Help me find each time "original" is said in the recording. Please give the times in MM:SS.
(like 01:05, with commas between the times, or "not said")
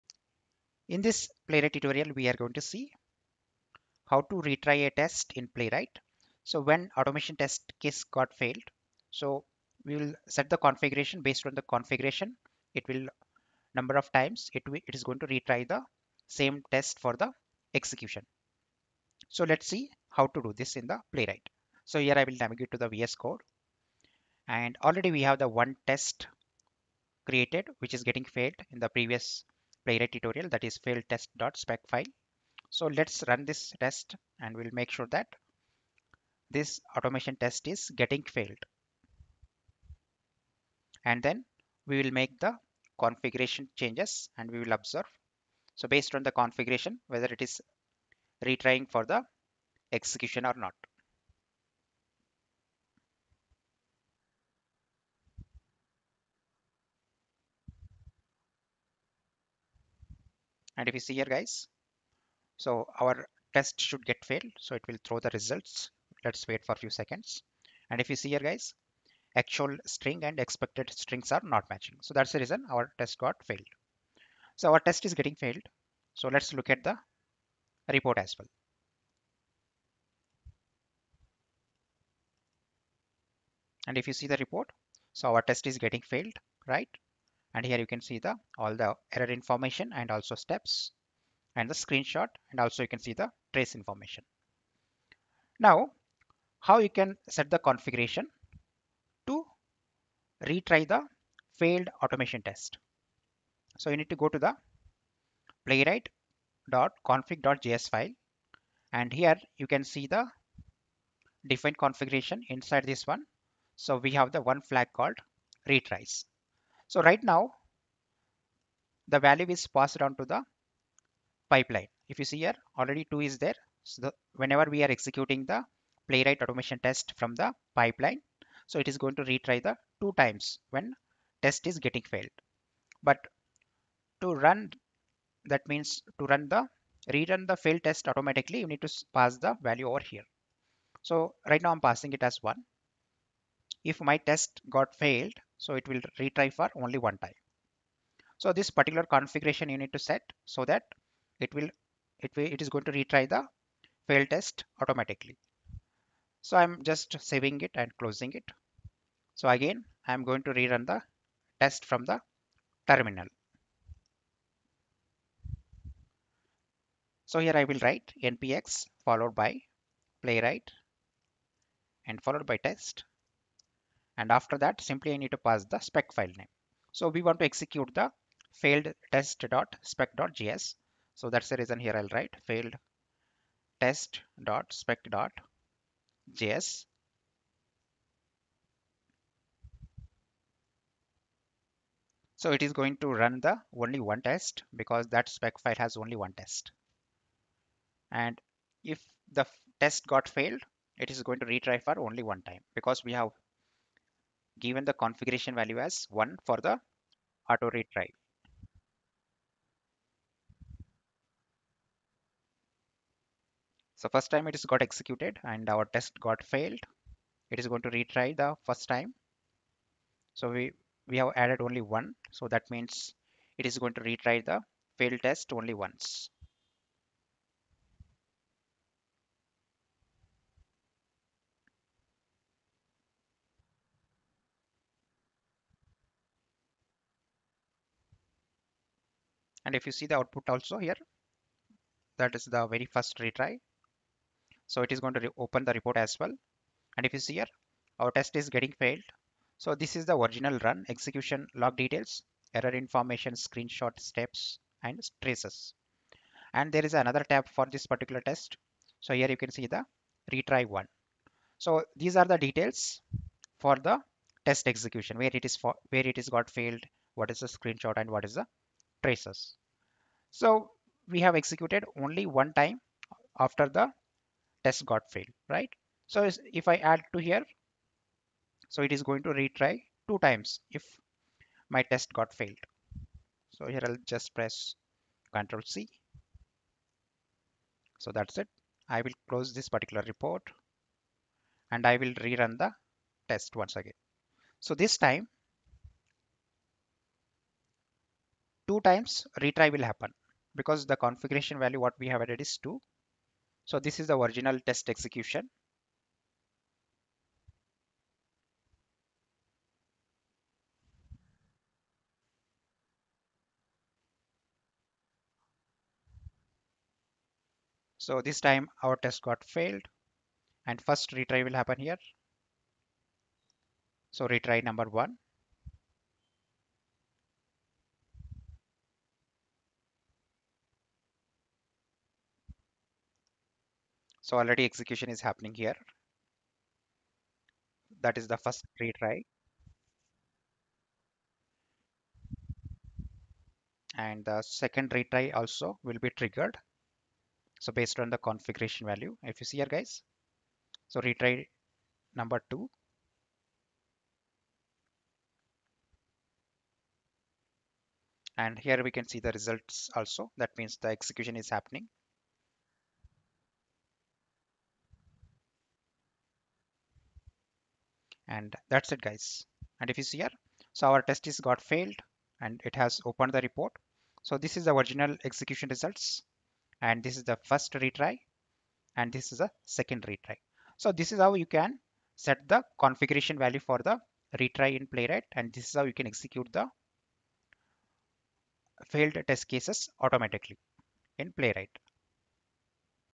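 04:10, 05:04, 06:14.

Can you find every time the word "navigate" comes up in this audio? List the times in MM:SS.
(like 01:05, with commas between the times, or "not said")
00:22.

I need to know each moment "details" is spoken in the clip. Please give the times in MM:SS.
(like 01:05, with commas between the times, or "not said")
04:11, 04:22.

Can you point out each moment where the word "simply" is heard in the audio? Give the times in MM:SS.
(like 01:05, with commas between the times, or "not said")
02:54.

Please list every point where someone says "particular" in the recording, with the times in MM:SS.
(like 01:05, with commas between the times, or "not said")
02:28, 04:17, 04:49.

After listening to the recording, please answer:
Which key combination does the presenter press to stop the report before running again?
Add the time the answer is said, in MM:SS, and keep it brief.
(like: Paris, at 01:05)
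Control C, at 04:45.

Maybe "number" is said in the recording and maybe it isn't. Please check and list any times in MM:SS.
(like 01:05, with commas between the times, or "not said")
00:13, 05:24, 05:52.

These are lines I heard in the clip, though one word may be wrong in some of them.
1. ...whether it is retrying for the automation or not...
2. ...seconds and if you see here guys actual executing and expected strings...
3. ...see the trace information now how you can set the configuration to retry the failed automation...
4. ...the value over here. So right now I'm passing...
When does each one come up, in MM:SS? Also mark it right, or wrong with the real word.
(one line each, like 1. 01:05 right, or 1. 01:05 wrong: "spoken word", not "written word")
1. 00:47 wrong: "execution", not "automation"
2. 01:06 wrong: "string", not "executing"
3. 01:32 right
4. 02:19 right.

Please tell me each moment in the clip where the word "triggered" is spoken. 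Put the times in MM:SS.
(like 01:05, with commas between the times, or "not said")
05:46.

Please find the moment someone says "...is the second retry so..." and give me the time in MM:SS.
06:19.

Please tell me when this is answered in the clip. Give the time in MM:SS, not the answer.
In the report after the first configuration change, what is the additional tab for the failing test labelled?
04:20.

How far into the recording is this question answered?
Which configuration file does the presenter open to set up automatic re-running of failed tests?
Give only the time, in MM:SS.
01:45.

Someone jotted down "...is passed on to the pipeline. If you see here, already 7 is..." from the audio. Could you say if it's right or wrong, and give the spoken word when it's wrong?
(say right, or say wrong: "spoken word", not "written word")
wrong: "2", not "7".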